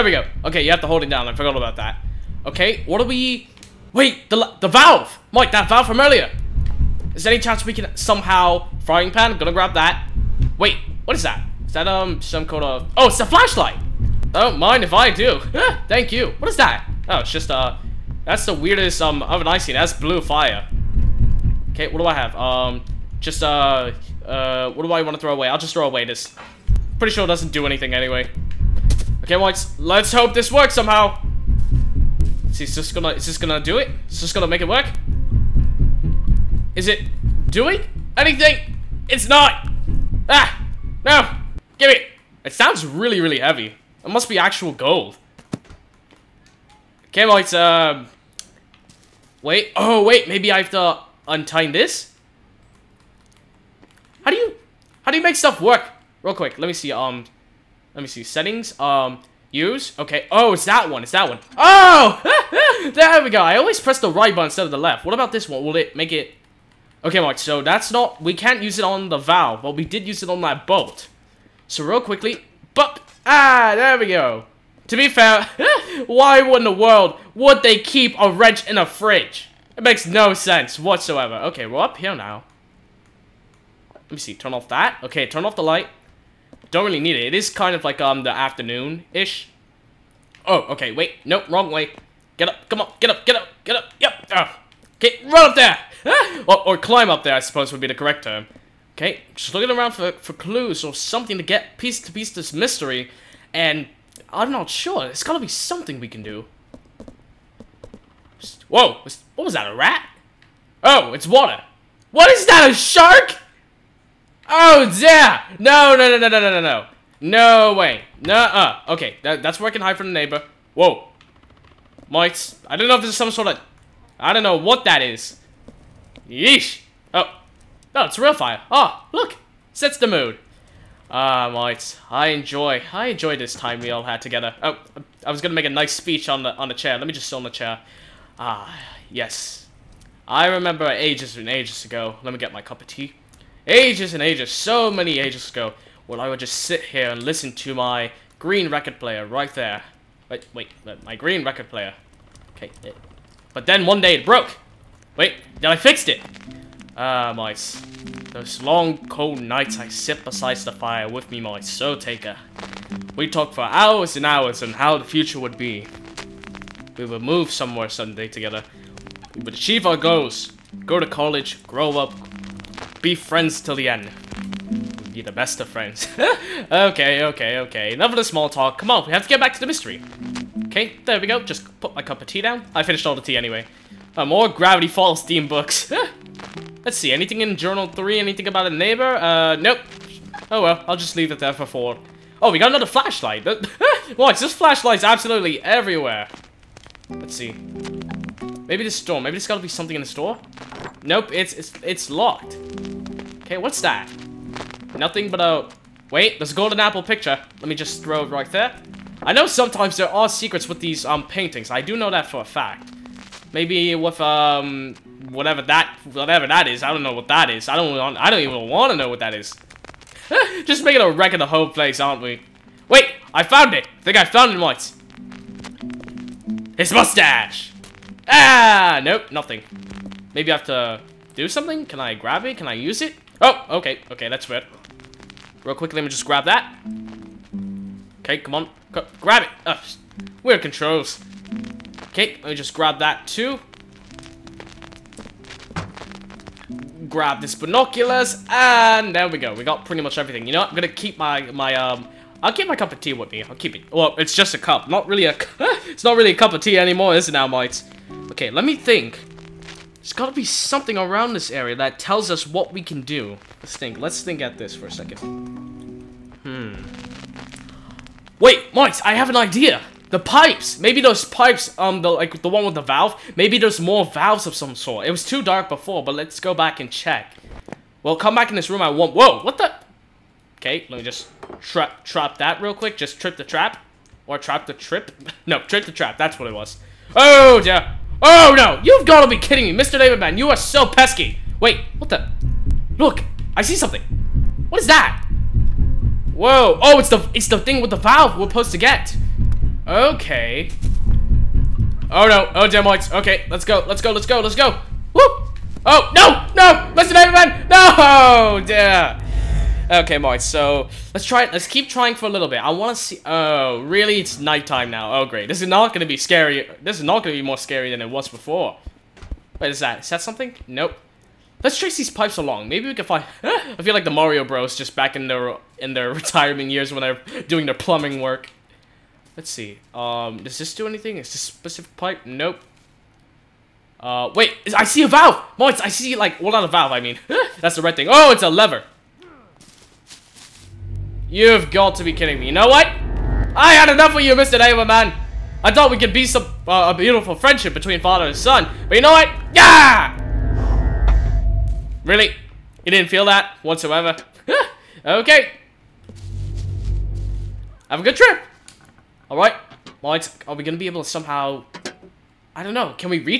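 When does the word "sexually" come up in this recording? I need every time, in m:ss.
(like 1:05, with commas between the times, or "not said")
not said.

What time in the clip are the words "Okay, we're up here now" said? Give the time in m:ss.
1:21.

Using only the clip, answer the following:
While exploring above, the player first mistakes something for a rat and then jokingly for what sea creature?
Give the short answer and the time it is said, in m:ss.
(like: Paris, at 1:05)
Shark, at 1:52.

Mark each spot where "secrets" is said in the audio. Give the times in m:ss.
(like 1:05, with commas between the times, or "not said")
3:30.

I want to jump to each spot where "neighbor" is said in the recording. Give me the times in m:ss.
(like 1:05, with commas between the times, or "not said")
2:00, 3:08.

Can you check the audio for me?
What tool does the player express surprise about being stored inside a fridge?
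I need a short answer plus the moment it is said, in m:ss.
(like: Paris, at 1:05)
Wrench, at 1:18.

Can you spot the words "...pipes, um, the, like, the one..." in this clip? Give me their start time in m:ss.
4:31.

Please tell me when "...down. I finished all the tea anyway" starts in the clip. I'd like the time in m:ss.
3:02.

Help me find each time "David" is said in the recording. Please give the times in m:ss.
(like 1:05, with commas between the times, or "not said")
4:49, 5:07.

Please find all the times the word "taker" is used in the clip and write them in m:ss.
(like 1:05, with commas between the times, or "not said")
2:41.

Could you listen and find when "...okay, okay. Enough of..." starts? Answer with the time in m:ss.
2:57.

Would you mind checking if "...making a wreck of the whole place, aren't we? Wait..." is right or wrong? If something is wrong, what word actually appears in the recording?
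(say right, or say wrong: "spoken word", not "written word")
right.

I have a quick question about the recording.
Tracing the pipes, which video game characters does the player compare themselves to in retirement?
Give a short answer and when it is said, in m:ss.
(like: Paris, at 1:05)
Mario Bros, at 5:24.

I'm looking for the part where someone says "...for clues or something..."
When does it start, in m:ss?
1:40.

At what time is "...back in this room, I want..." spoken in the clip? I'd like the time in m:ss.
4:38.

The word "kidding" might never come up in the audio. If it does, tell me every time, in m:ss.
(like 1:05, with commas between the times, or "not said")
4:49, 5:42.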